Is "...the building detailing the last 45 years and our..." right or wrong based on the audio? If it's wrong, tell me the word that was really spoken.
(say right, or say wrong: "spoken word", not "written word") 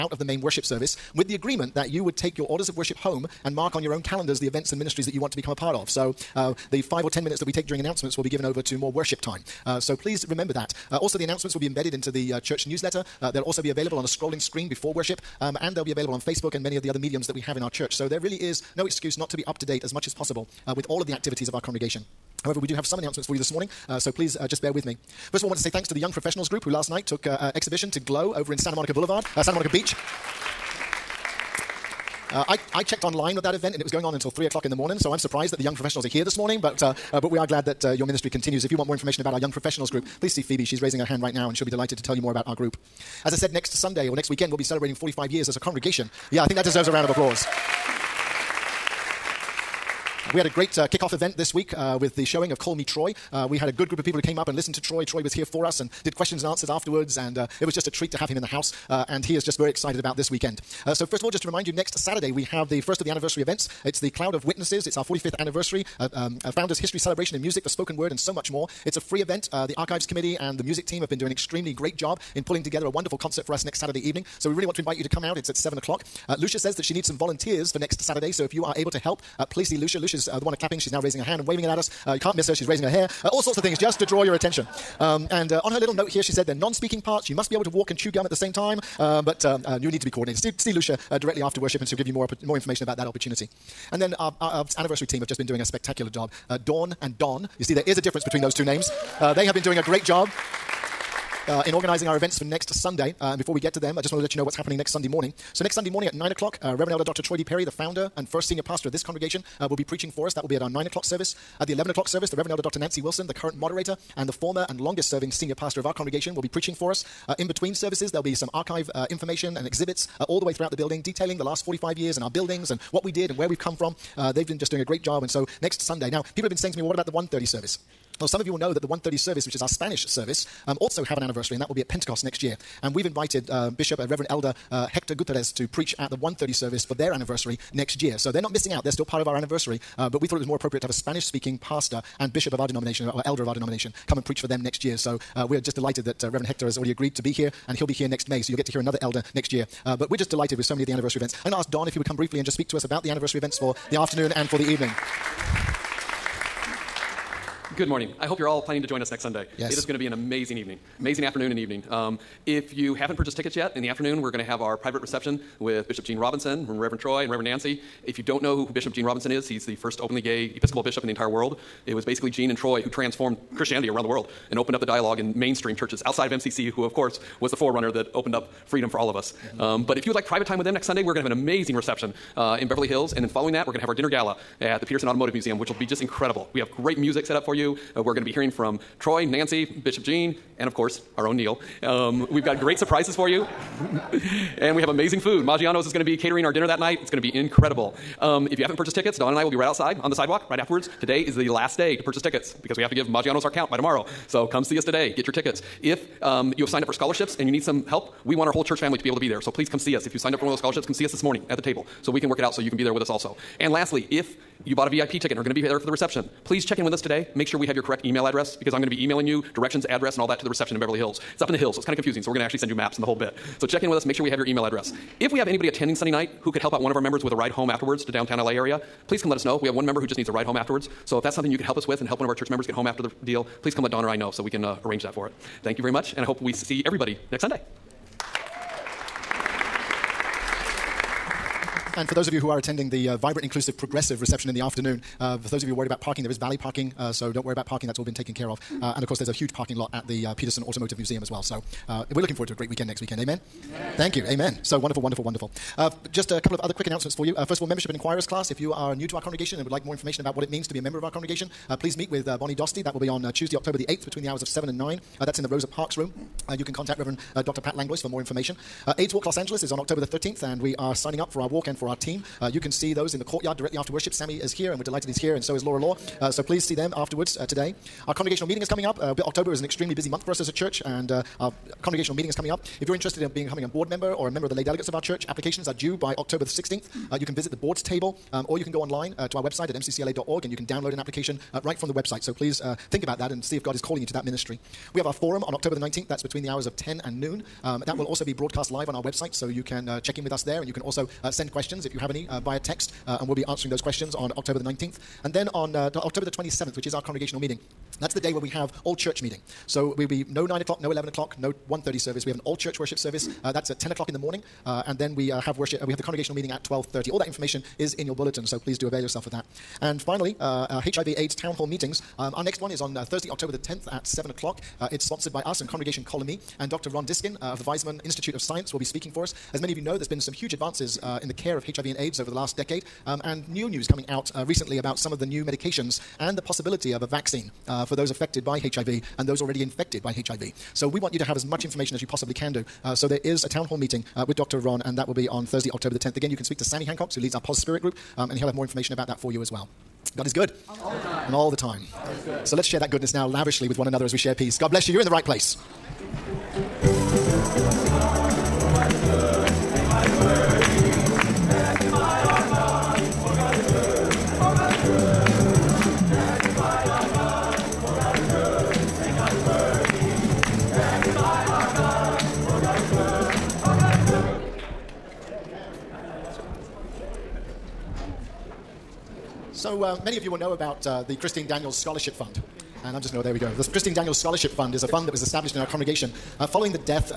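right.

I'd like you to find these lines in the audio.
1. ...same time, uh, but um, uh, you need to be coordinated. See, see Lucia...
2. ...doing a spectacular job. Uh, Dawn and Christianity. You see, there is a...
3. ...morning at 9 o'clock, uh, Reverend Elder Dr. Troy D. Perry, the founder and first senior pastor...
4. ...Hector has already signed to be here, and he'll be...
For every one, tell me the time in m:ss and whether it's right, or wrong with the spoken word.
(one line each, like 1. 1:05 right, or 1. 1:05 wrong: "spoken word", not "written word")
1. 1:28 right
2. 1:35 wrong: "Don", not "Christianity"
3. 1:45 right
4. 2:26 wrong: "agreed", not "signed".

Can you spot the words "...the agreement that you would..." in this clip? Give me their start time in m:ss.
0:01.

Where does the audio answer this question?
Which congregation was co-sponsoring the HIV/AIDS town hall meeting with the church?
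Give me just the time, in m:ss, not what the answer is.
5:25.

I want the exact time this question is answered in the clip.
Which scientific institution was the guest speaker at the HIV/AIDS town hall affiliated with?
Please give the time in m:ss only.
5:27.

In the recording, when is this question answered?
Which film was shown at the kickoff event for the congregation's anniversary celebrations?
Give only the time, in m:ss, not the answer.
0:52.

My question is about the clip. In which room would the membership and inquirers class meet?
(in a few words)
Rosa Parks room.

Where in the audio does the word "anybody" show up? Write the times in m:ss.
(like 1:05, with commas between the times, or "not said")
3:45.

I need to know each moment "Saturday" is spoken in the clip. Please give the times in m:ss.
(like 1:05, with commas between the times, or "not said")
1:01, 1:13, 1:18.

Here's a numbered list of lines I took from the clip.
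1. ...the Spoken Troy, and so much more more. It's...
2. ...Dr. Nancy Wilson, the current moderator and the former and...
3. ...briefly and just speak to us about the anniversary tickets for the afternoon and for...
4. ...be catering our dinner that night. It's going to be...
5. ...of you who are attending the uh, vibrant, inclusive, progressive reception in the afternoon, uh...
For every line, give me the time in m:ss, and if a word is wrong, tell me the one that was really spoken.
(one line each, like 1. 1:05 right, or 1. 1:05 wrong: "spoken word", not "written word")
1. 1:07 wrong: "Word", not "Troy"
2. 1:52 right
3. 2:32 wrong: "events", not "tickets"
4. 3:16 right
5. 4:02 right.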